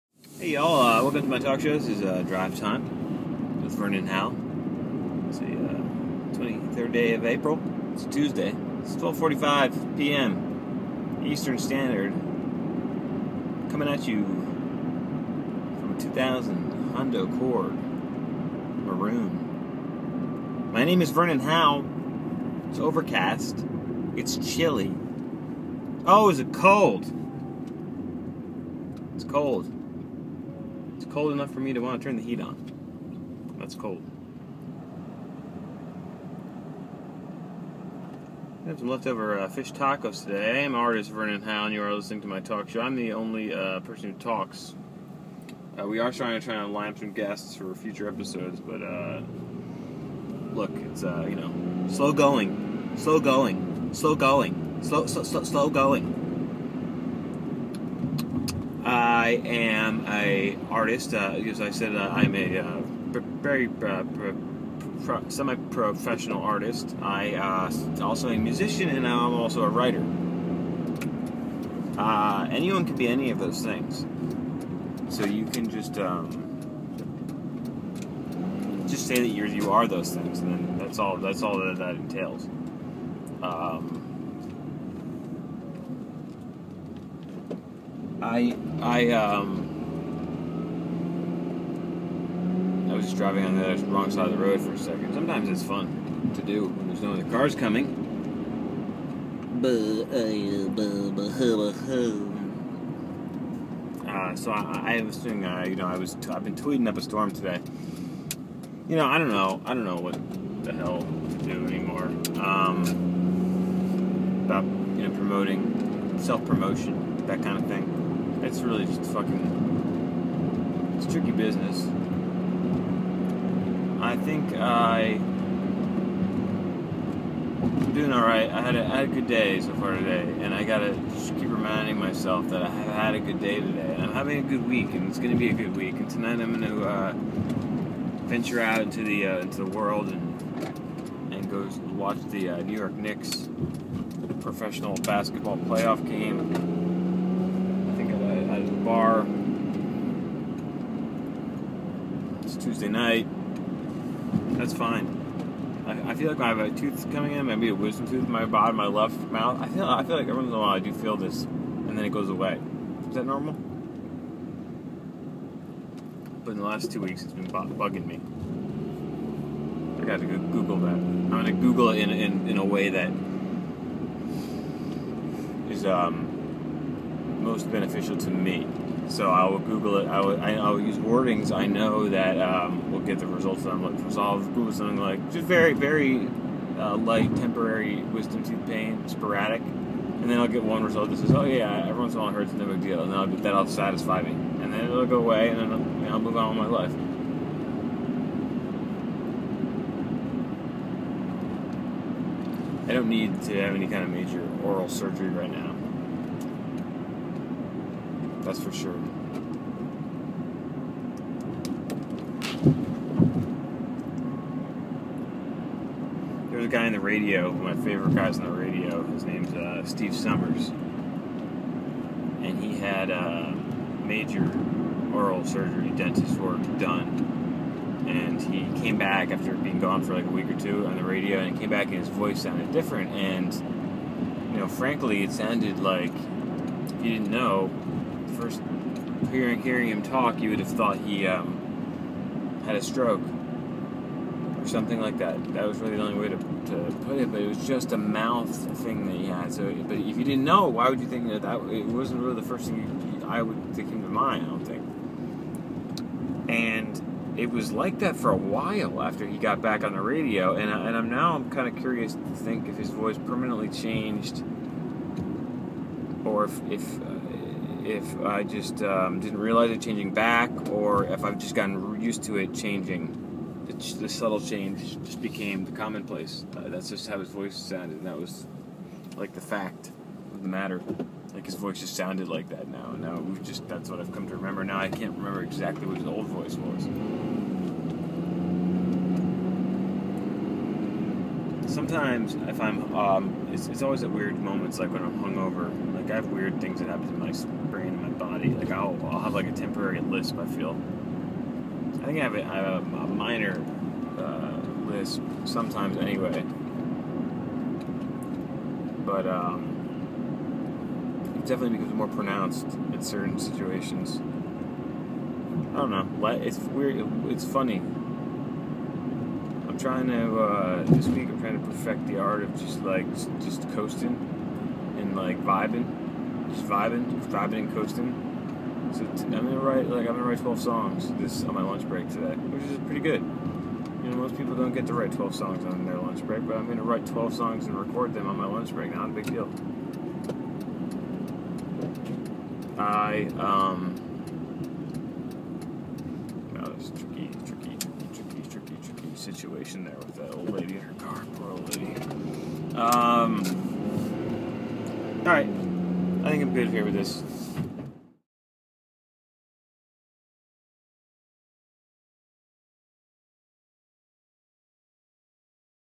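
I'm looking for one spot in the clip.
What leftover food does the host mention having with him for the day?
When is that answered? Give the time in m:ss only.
0:39.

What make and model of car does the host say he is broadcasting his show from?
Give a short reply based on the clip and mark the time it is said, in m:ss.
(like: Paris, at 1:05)
2000 Honda Accord, at 0:16.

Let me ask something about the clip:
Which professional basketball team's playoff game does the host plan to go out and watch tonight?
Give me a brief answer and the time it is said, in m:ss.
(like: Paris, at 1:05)
New York Knicks, at 2:22.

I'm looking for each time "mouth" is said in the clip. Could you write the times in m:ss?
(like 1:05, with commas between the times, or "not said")
2:39, 4:07.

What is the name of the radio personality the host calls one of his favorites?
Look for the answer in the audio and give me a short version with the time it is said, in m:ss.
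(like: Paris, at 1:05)
Steve Summers, at 3:39.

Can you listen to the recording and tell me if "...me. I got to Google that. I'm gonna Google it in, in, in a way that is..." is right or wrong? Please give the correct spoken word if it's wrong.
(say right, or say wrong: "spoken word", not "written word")
right.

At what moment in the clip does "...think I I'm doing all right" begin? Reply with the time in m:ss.
2:04.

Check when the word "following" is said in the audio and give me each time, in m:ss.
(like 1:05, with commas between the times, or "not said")
not said.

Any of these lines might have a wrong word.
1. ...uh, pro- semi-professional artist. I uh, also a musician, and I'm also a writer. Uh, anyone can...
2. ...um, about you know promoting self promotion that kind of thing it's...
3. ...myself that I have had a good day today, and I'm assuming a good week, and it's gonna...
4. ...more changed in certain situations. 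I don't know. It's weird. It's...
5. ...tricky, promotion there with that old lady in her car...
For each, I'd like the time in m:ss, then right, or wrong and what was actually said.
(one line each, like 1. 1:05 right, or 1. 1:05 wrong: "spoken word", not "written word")
1. 1:03 right
2. 1:52 right
3. 2:11 wrong: "having", not "assuming"
4. 5:11 wrong: "pronounced", not "changed"
5. 5:48 wrong: "situation", not "promotion".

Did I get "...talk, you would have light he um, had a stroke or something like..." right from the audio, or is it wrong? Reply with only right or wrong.
wrong.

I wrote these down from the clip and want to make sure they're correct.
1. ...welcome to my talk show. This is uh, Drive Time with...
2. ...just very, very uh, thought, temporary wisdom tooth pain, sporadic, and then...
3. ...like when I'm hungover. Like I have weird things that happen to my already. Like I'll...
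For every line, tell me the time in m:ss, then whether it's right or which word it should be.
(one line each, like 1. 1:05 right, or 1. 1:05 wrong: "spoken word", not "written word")
1. 0:01 right
2. 3:05 wrong: "light", not "thought"
3. 4:54 right.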